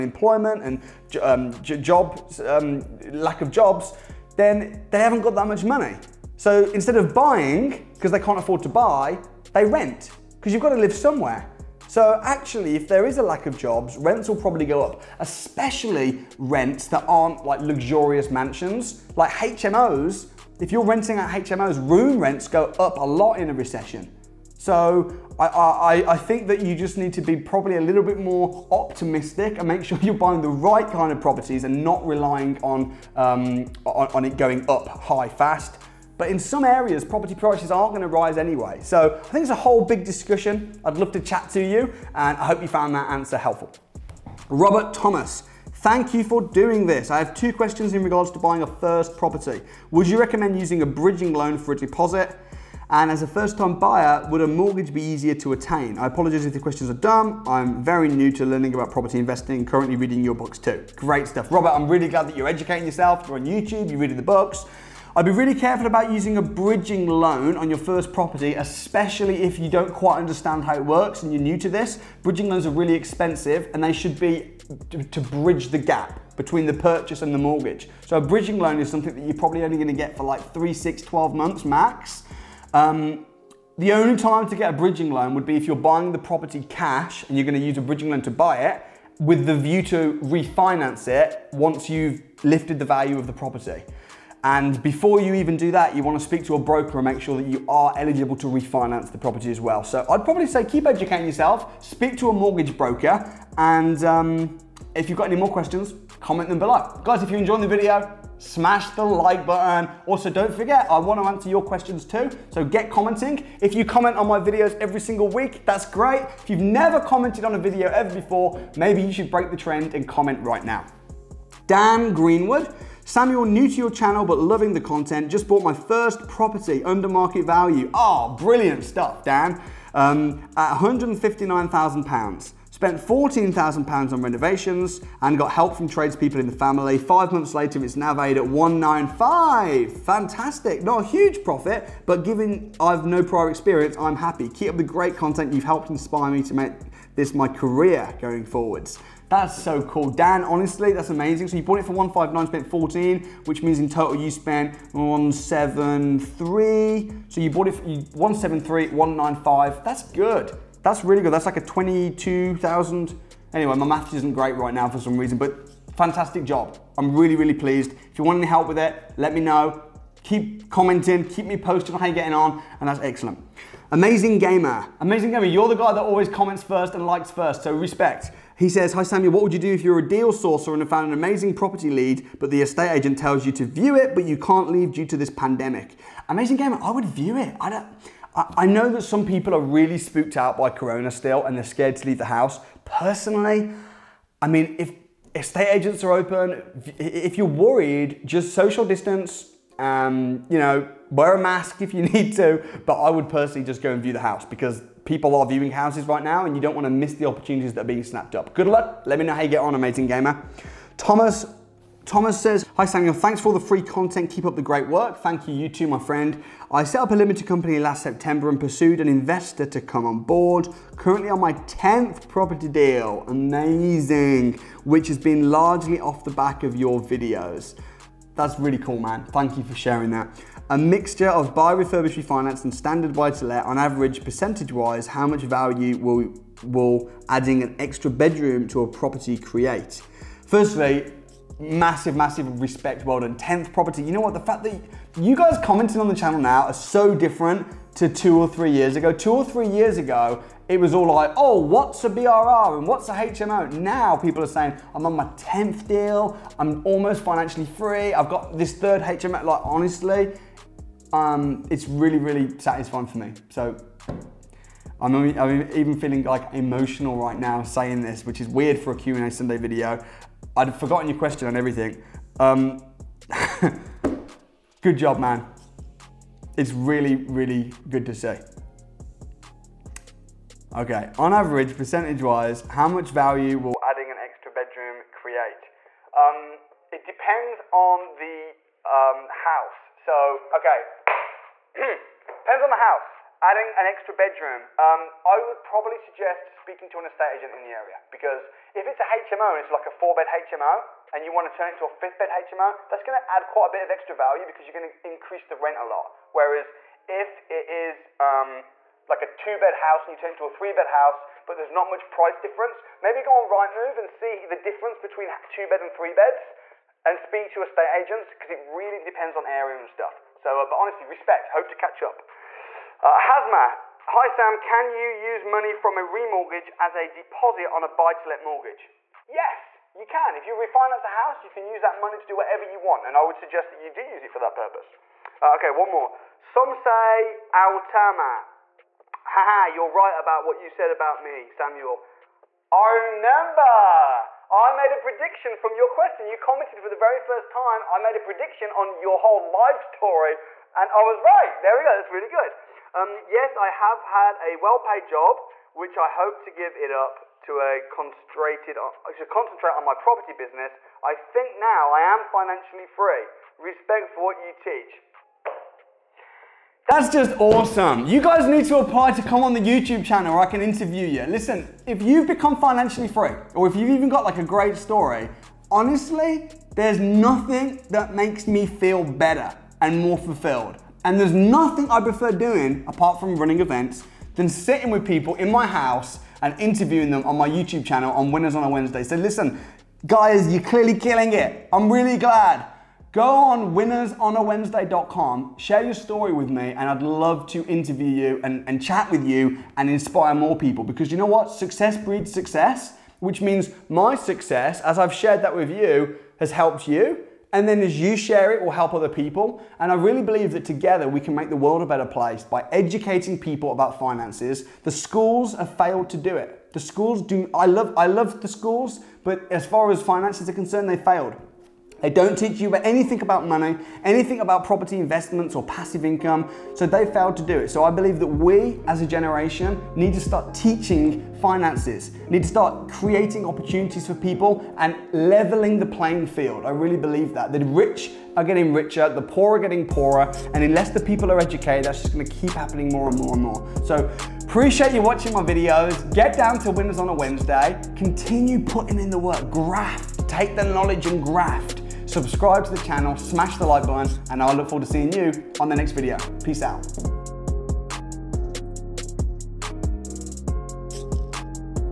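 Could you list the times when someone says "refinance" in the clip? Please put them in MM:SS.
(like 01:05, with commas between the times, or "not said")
01:30, 01:38, 03:52, 05:30.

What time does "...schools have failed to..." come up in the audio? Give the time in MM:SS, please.
06:54.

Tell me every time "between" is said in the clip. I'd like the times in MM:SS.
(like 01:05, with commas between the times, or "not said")
01:16, 05:14.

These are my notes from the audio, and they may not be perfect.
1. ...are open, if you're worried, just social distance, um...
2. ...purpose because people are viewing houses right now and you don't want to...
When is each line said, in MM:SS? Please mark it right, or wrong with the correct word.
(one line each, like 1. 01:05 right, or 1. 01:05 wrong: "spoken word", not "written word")
1. 03:16 right
2. 03:24 wrong: "house", not "purpose".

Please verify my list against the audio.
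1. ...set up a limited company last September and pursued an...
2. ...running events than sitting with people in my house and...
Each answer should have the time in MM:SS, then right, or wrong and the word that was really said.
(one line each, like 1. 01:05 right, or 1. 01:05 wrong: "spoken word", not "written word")
1. 03:36 right
2. 06:23 right.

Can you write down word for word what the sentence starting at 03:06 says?
Amazing Gamer, I would view it.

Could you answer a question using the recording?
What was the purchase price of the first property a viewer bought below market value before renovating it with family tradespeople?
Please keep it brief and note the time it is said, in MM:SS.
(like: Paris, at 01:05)
£159,000, at 02:10.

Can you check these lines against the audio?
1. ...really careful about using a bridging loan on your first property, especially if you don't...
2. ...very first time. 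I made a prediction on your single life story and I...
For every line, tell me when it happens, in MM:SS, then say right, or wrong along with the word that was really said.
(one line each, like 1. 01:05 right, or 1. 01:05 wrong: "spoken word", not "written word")
1. 01:05 right
2. 05:46 wrong: "whole", not "single".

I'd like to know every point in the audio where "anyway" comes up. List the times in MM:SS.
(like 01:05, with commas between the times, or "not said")
00:38, 02:43.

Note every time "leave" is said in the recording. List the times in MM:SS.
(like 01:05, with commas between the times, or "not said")
03:04, 03:12.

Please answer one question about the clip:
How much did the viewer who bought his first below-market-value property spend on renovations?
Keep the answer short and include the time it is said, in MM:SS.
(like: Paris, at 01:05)
£14,000, at 02:12.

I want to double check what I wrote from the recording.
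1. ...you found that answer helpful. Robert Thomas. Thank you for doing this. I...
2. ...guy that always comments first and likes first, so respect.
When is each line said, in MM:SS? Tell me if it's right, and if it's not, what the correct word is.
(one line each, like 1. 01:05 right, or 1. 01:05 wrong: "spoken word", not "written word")
1. 00:42 right
2. 02:55 right.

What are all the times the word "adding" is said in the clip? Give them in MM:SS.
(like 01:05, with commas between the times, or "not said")
03:57, 04:43, 04:53.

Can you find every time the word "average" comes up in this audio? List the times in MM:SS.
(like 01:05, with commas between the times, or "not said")
03:53, 04:41.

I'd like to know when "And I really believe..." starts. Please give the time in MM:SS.
06:49.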